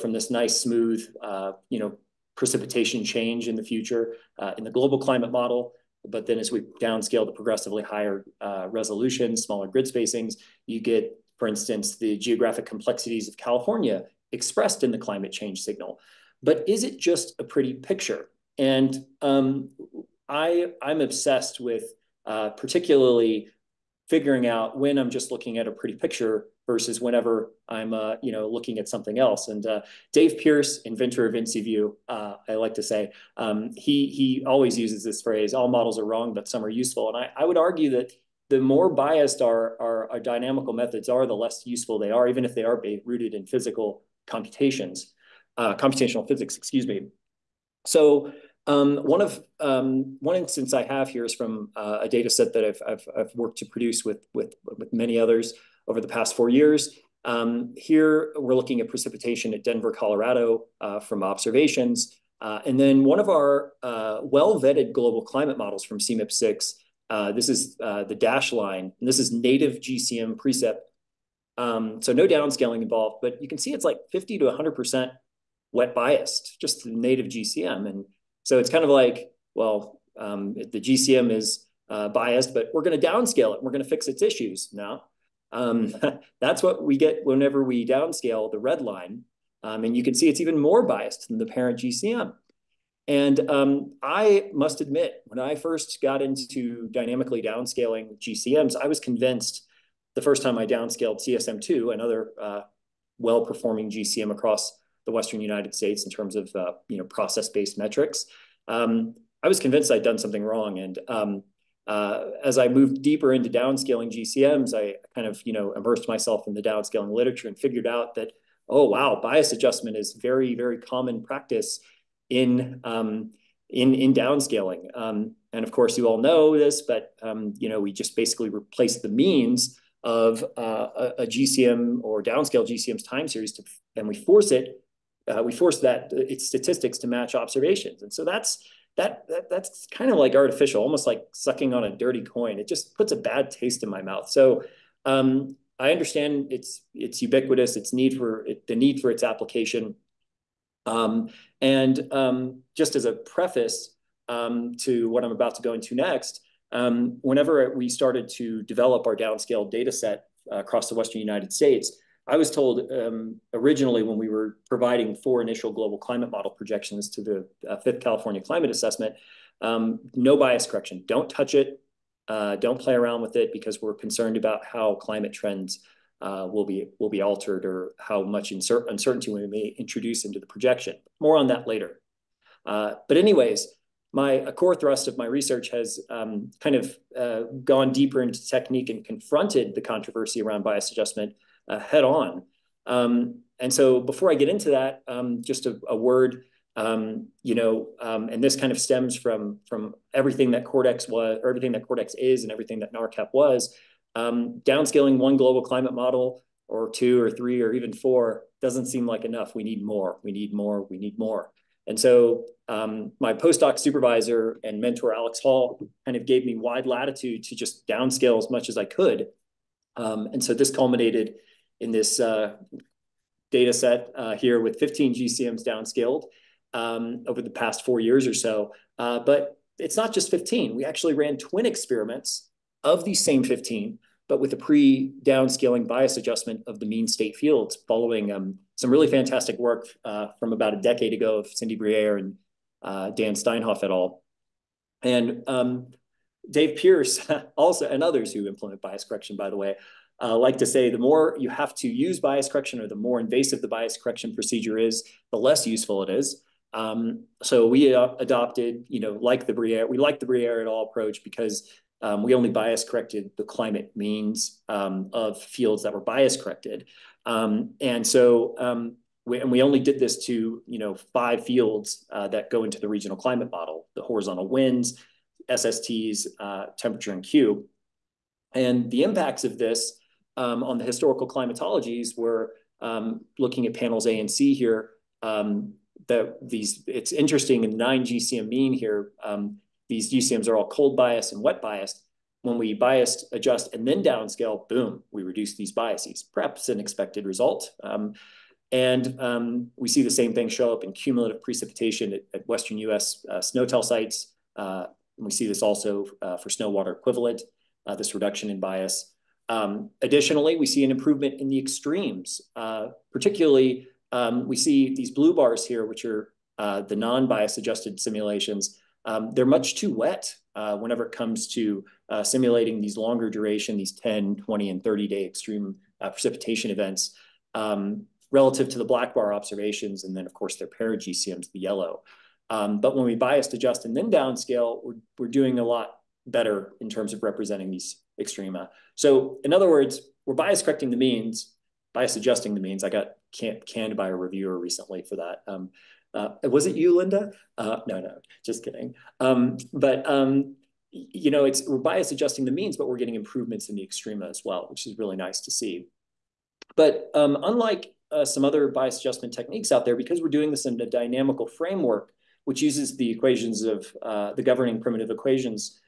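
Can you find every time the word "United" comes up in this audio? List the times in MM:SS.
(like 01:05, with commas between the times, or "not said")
01:45, 02:41.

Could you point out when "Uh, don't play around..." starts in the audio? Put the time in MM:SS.
02:52.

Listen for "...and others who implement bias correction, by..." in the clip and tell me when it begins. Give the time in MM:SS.
04:07.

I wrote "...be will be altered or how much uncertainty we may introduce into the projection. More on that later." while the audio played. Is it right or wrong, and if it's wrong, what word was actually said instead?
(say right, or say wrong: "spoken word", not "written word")
right.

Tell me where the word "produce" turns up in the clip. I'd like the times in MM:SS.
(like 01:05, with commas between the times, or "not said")
00:53.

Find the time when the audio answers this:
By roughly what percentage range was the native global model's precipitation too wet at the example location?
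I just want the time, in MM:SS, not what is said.
01:14.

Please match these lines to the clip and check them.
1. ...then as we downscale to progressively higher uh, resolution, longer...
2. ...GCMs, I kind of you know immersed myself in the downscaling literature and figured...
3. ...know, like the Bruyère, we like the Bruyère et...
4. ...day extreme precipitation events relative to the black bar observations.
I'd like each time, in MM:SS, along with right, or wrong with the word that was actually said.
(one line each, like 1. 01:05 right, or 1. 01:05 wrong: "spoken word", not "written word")
1. 00:06 wrong: "smaller", not "longer"
2. 01:54 right
3. 04:18 right
4. 05:25 right.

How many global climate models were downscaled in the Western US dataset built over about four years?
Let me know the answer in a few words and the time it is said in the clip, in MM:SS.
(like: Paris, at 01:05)
15, at 03:44.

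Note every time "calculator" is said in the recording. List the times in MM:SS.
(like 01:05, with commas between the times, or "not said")
not said.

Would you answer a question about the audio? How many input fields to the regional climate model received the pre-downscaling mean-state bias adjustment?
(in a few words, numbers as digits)
5.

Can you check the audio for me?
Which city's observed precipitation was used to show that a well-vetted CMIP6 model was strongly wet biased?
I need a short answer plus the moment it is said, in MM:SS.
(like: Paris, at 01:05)
Denver, Colorado, at 00:59.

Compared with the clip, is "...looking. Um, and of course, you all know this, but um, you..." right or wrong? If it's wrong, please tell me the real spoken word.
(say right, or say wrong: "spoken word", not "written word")
wrong: "downscaling", not "looking".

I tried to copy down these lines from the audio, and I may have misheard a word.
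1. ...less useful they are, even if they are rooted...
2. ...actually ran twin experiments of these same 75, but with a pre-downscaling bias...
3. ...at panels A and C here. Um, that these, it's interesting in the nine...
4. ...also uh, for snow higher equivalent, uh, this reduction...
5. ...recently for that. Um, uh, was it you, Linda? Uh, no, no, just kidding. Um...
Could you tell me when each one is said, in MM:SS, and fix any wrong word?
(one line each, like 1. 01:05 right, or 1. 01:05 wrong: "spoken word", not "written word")
1. 00:41 right
2. 03:50 wrong: "15", not "75"
3. 04:43 right
4. 05:05 wrong: "water", not "higher"
5. 05:44 right.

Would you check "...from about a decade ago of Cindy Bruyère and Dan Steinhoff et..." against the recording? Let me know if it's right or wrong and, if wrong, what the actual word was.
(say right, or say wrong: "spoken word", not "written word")
right.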